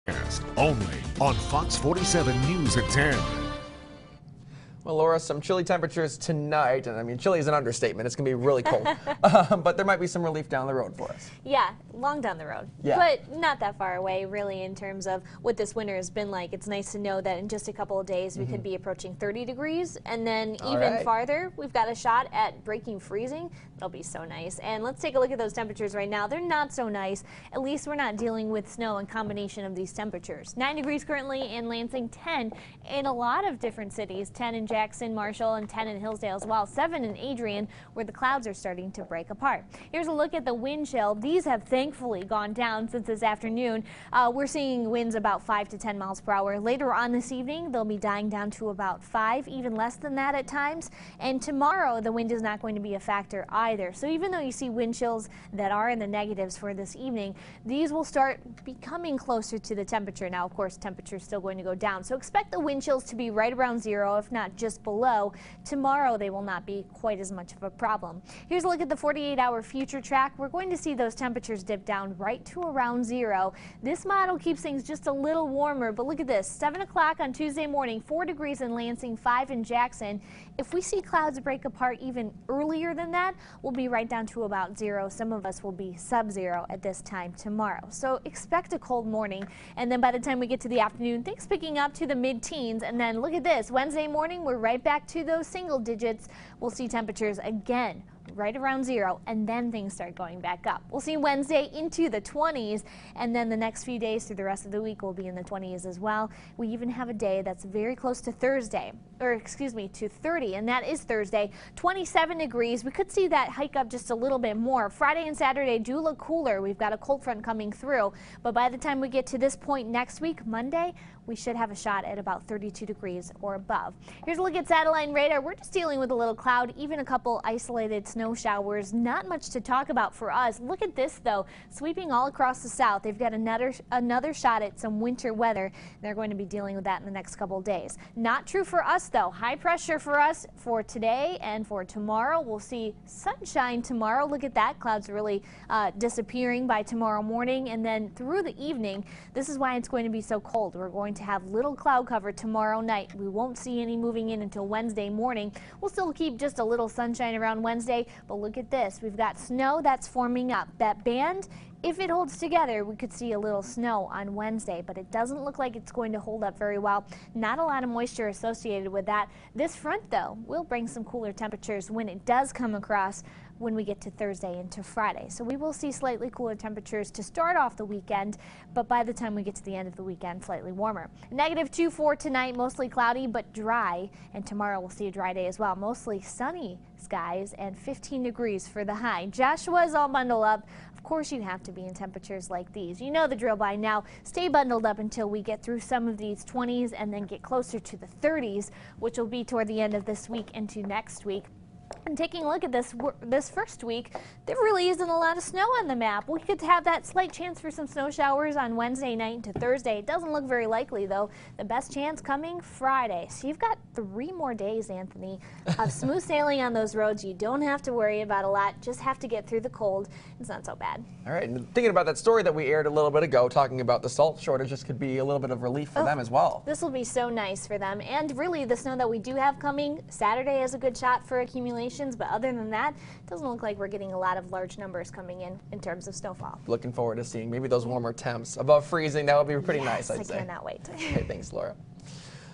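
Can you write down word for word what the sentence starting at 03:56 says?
Looking forward to seeing maybe those warmer temps above freezing.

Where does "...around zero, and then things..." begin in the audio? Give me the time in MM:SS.
01:38.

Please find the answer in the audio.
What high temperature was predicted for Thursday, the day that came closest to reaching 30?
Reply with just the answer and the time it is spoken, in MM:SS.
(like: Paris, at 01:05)
27 degrees, at 01:51.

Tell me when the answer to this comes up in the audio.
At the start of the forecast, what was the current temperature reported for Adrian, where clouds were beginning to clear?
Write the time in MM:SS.
00:36.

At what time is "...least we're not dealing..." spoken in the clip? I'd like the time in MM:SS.
00:27.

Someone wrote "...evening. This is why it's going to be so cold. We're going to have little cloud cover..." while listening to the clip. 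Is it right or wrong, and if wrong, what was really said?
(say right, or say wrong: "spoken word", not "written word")
right.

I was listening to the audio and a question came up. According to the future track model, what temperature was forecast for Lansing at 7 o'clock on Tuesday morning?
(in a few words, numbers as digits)
4 degrees.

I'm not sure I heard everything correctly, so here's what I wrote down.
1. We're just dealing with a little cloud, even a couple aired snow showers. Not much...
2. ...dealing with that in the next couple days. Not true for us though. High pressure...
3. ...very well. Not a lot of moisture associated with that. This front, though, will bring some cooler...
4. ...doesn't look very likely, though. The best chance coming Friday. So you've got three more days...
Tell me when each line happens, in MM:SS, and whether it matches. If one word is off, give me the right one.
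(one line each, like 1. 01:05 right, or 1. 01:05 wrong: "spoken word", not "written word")
1. 02:05 wrong: "isolated", not "aired"
2. 02:16 right
3. 02:46 right
4. 03:30 right.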